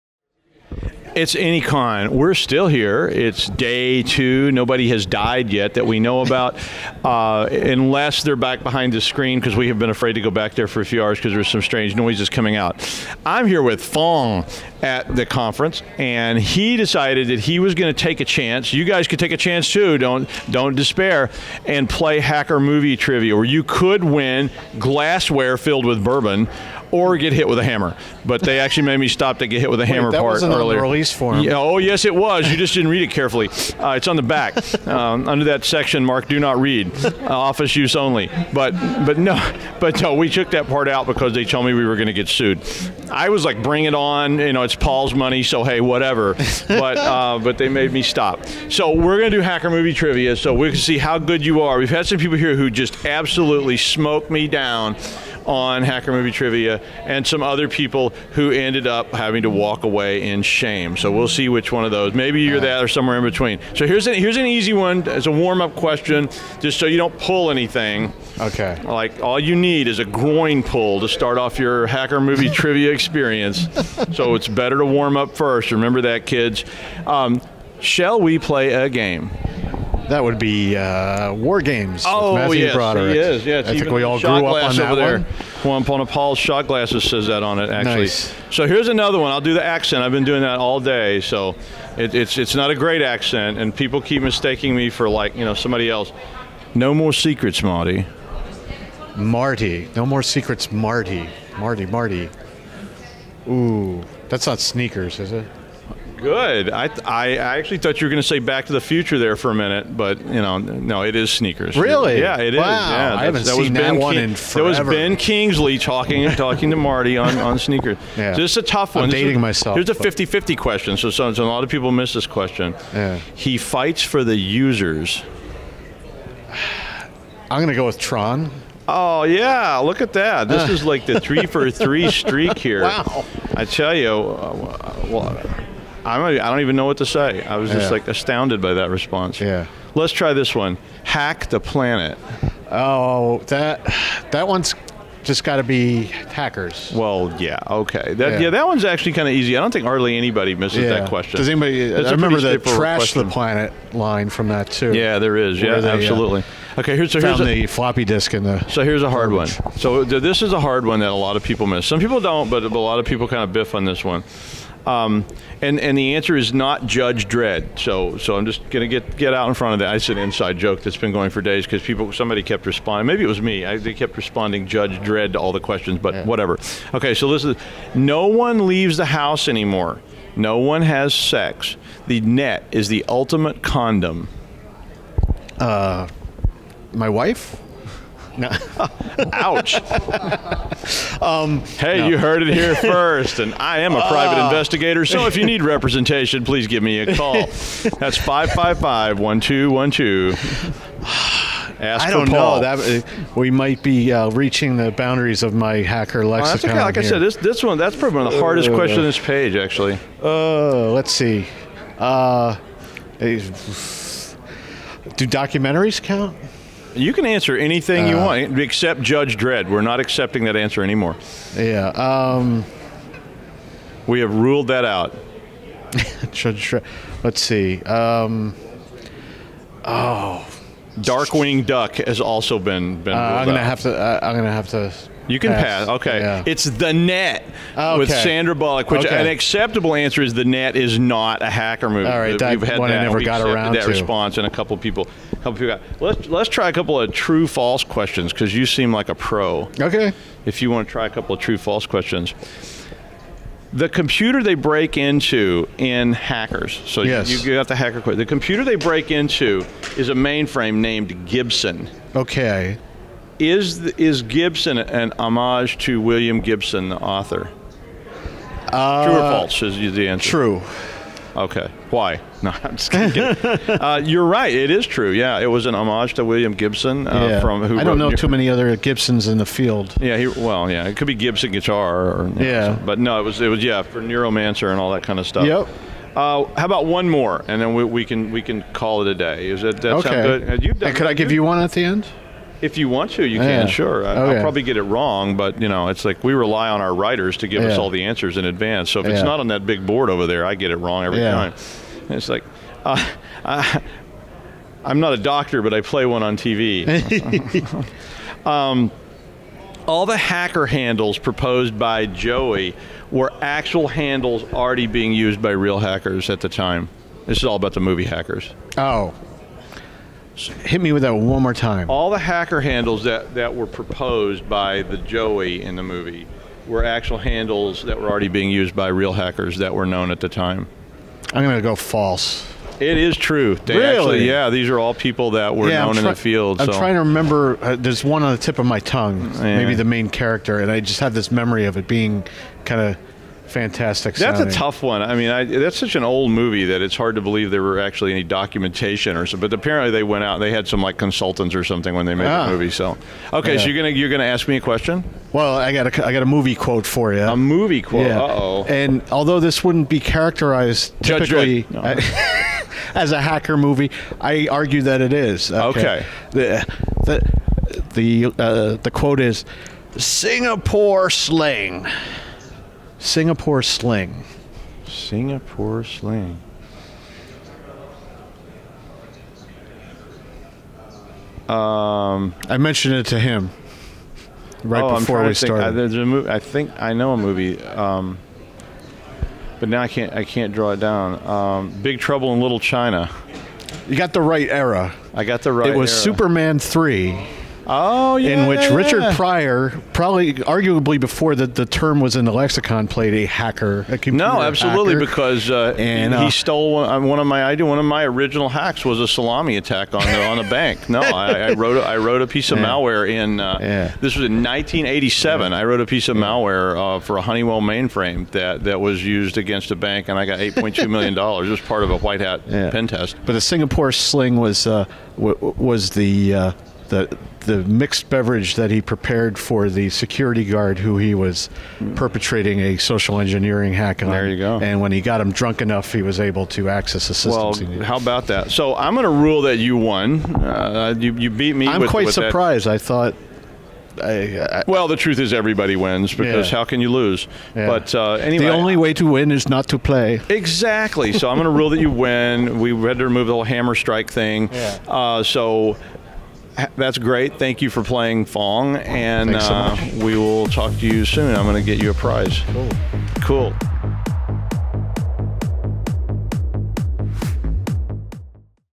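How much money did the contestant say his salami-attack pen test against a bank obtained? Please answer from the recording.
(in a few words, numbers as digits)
$8.2 million.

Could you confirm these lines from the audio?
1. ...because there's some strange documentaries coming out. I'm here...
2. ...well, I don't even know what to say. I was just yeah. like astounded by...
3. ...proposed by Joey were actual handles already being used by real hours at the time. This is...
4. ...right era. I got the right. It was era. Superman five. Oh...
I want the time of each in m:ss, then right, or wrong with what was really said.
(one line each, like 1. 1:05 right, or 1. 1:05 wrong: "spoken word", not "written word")
1. 0:11 wrong: "noises", not "documentaries"
2. 2:15 right
3. 5:11 wrong: "hackers", not "hours"
4. 6:34 wrong: "three", not "five".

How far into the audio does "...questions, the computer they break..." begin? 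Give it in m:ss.
4:11.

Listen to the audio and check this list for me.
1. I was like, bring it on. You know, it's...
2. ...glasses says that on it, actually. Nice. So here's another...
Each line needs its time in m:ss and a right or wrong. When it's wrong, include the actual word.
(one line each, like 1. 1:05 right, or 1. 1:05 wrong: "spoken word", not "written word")
1. 0:43 right
2. 1:26 right.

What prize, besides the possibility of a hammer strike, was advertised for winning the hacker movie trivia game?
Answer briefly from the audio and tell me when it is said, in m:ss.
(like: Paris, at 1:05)
Glassware filled with bourbon, at 0:24.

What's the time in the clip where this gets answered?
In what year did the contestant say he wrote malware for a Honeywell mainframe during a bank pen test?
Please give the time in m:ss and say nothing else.
6:54.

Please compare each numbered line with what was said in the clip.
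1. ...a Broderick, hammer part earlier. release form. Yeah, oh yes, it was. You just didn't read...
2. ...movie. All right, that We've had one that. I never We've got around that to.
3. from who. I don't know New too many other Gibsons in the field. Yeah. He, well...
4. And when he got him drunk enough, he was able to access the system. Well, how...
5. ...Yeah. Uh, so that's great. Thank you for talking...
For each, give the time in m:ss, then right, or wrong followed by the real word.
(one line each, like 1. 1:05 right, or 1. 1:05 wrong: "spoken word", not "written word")
1. 0:29 wrong: "Wait", not "Broderick"
2. 4:01 right
3. 4:37 right
4. 7:14 right
5. 7:34 wrong: "playing", not "talking".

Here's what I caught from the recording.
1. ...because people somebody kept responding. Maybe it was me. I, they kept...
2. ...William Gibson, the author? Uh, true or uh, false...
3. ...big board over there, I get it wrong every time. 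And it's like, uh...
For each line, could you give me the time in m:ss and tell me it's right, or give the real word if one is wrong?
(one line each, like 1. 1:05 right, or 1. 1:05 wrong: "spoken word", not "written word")
1. 2:51 right
2. 4:26 right
3. 4:59 right.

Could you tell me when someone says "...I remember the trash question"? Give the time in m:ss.
2:32.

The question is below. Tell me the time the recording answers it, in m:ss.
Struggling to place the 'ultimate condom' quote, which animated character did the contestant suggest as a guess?
3:50.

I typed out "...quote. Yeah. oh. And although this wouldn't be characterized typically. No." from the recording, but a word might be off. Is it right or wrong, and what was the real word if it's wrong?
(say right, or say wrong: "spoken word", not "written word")
right.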